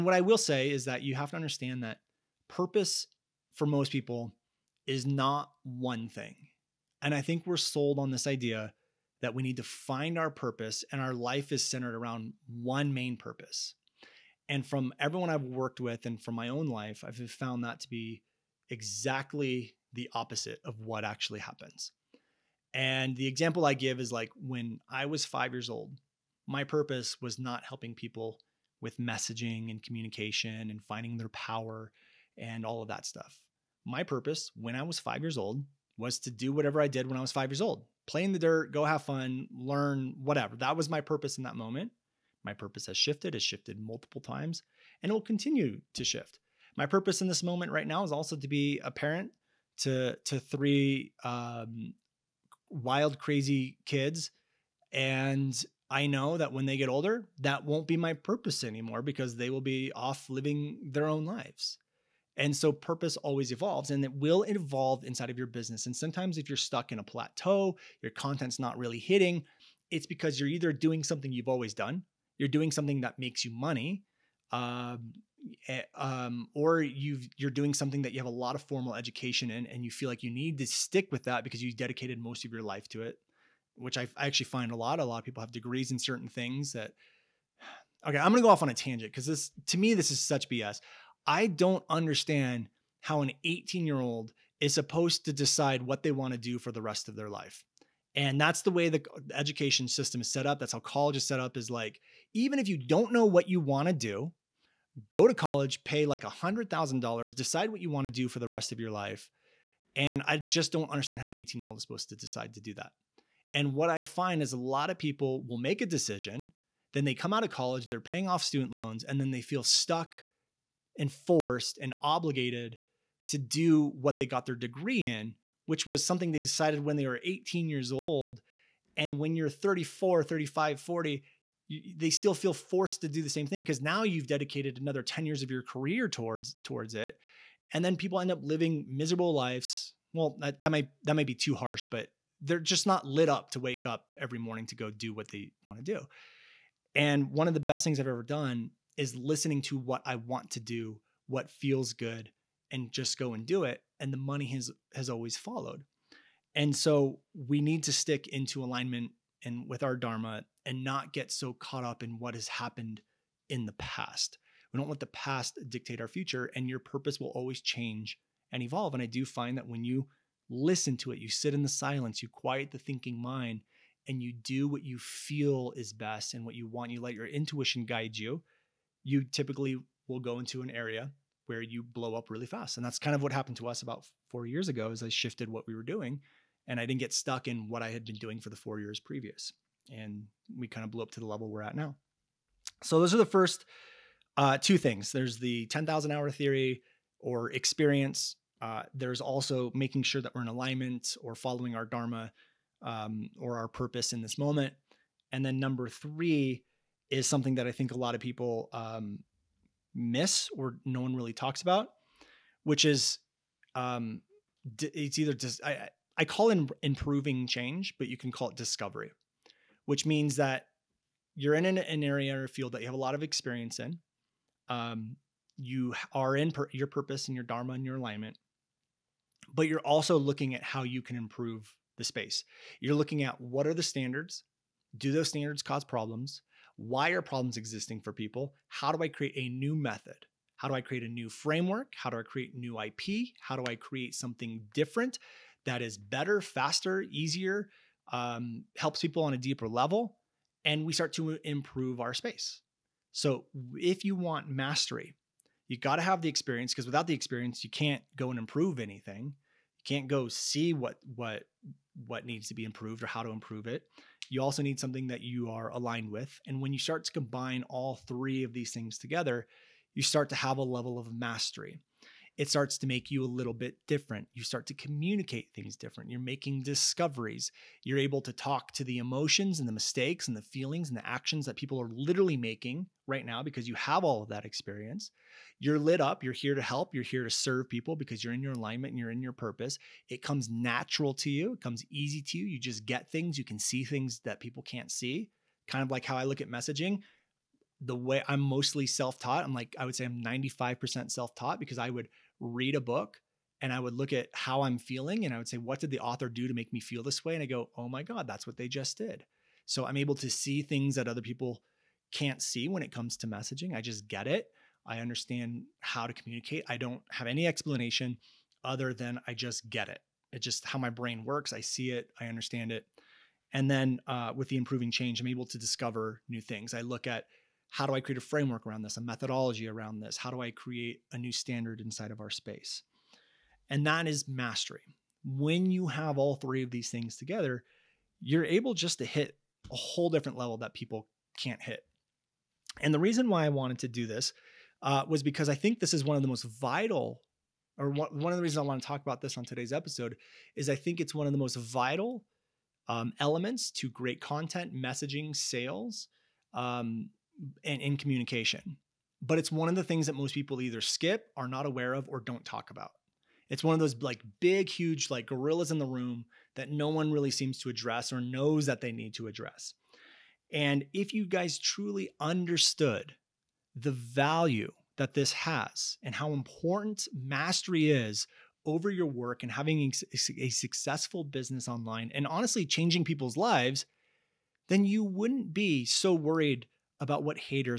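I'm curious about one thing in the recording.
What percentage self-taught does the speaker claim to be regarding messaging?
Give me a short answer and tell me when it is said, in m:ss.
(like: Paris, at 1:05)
95%, at 5:00.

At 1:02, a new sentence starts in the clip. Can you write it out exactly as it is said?
And so purpose always evolves and it will evolve inside of your business.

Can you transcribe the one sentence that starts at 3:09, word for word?
And we kind of blew up to the level we're at now.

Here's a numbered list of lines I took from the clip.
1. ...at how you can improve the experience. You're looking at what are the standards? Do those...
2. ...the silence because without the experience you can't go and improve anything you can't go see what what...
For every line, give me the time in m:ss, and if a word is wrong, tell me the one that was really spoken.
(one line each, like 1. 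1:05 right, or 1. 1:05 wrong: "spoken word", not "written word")
1. 3:50 wrong: "space", not "experience"
2. 4:16 wrong: "experience", not "silence".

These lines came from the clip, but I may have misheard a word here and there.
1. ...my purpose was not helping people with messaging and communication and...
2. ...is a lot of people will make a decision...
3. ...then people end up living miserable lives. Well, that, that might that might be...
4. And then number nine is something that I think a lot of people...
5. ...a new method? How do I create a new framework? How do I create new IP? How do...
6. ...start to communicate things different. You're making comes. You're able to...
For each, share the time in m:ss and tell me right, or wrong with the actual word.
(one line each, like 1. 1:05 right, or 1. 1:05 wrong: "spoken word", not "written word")
1. 0:26 right
2. 1:54 right
3. 2:17 right
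4. 3:25 wrong: "three", not "nine"
5. 3:59 right
6. 4:34 wrong: "discoveries", not "comes".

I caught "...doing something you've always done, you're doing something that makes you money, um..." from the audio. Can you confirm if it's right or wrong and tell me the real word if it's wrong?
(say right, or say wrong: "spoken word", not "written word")
right.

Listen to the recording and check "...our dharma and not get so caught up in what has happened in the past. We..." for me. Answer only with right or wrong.
right.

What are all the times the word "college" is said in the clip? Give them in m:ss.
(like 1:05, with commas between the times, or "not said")
1:40, 1:45, 1:57.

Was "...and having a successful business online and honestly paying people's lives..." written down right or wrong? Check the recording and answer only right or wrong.
wrong.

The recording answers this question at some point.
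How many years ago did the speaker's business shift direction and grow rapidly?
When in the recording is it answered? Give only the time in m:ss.
3:04.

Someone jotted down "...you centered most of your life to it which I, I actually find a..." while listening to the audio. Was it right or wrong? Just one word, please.
wrong.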